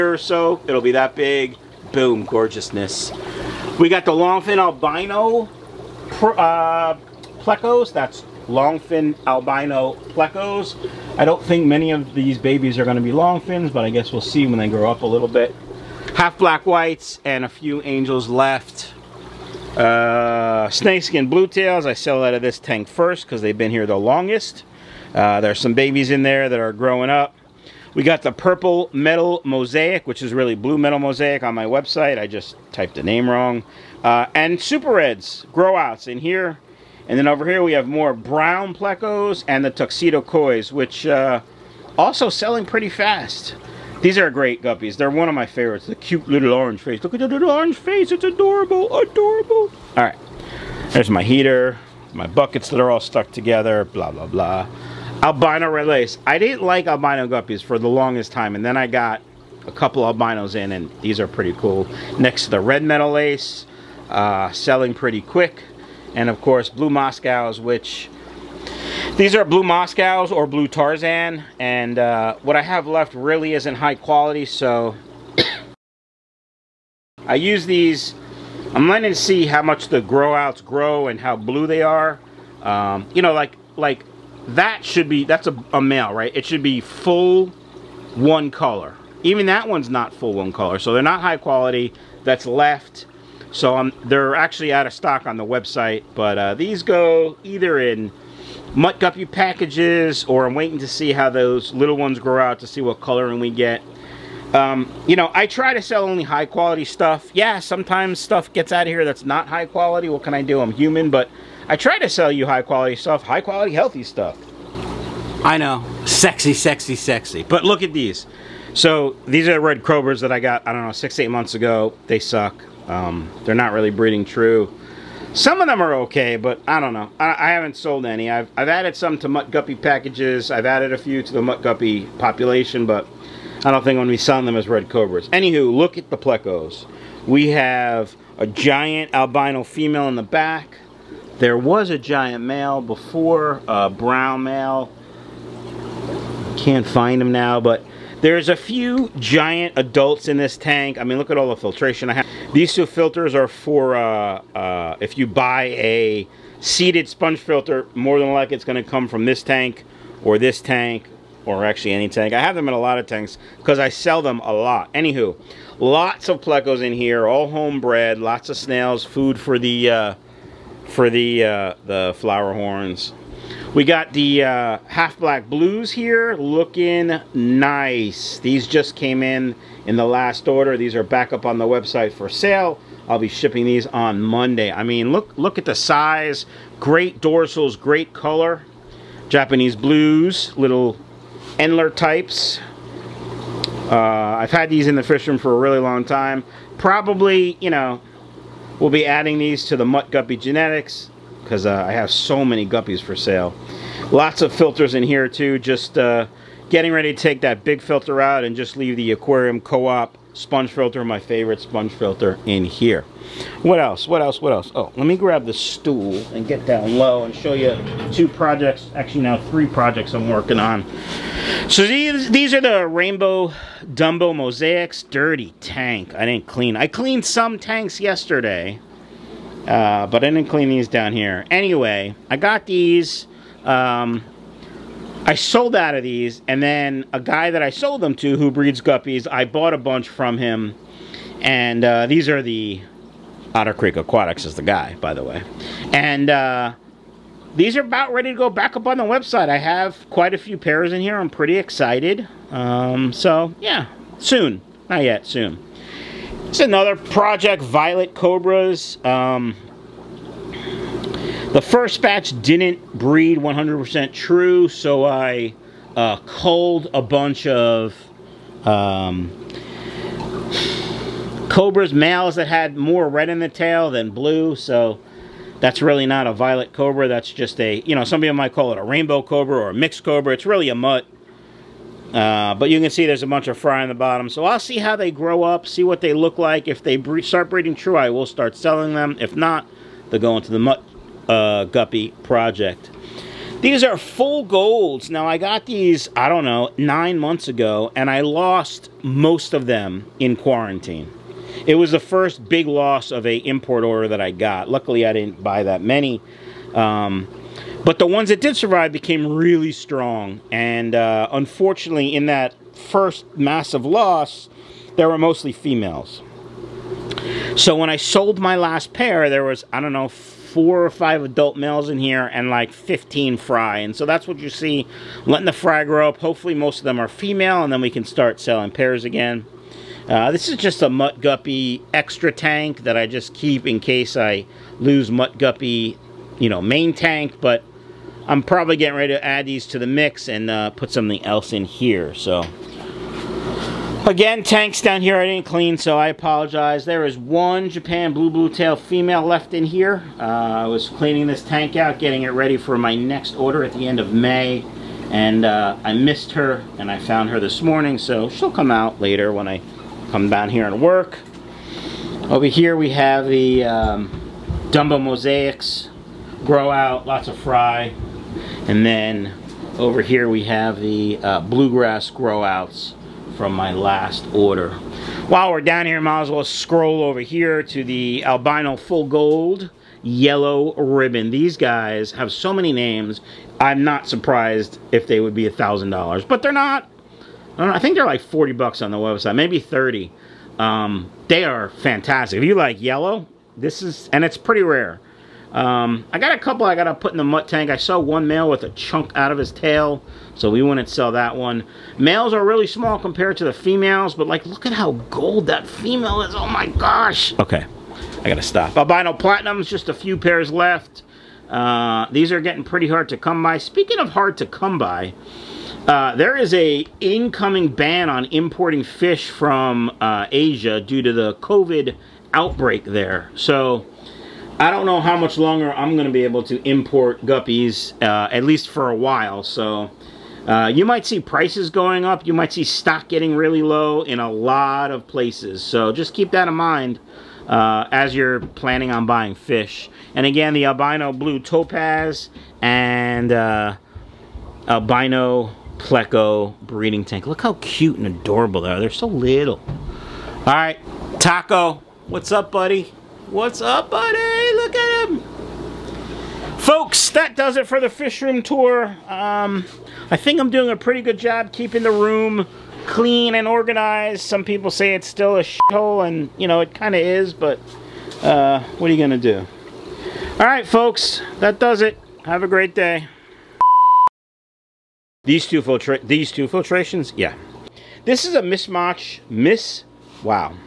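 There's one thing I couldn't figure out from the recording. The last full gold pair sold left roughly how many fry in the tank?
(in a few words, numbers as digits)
15.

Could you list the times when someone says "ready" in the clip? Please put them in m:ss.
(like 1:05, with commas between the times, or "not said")
3:26, 4:08, 5:38, 5:52.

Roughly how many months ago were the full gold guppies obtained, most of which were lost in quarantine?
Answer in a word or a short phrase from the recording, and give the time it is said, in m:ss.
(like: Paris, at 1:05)
9, at 4:56.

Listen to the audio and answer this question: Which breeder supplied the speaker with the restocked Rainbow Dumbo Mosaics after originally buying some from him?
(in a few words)
Otter Creek Aquatics.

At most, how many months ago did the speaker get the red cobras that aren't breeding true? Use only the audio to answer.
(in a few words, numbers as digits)
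8.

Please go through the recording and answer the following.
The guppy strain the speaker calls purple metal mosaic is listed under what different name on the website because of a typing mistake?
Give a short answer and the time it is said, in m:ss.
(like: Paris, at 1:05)
blue metal mosaic, at 0:30.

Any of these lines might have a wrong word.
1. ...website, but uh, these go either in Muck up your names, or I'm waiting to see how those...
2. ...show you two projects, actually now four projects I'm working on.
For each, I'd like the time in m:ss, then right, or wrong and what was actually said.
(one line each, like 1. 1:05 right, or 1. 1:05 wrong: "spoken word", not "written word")
1. 1:35 wrong: "packages", not "names"
2. 3:37 wrong: "three", not "four".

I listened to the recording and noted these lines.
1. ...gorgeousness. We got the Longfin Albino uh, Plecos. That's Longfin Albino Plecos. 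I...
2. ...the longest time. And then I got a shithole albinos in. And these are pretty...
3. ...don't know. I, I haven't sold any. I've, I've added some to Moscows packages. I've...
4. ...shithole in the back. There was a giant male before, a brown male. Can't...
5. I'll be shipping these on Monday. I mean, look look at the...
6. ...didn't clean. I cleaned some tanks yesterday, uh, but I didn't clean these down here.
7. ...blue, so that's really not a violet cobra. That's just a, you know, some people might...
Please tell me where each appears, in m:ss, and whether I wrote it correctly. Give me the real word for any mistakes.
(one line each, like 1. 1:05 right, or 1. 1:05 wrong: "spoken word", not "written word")
1. 0:02 right
2. 0:57 wrong: "couple", not "shithole"
3. 2:06 wrong: "Mutt", not "Moscows"
4. 2:19 wrong: "female", not "shithole"
5. 3:03 right
6. 3:46 right
7. 4:34 right.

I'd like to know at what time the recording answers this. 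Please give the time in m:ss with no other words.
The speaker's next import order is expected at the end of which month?
5:53.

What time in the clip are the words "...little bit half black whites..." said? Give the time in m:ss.
0:15.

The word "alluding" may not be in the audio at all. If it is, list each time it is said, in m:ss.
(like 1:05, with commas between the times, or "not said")
not said.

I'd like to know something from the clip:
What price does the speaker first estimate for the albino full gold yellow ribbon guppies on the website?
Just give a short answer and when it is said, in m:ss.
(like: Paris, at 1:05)
$40, at 6:28.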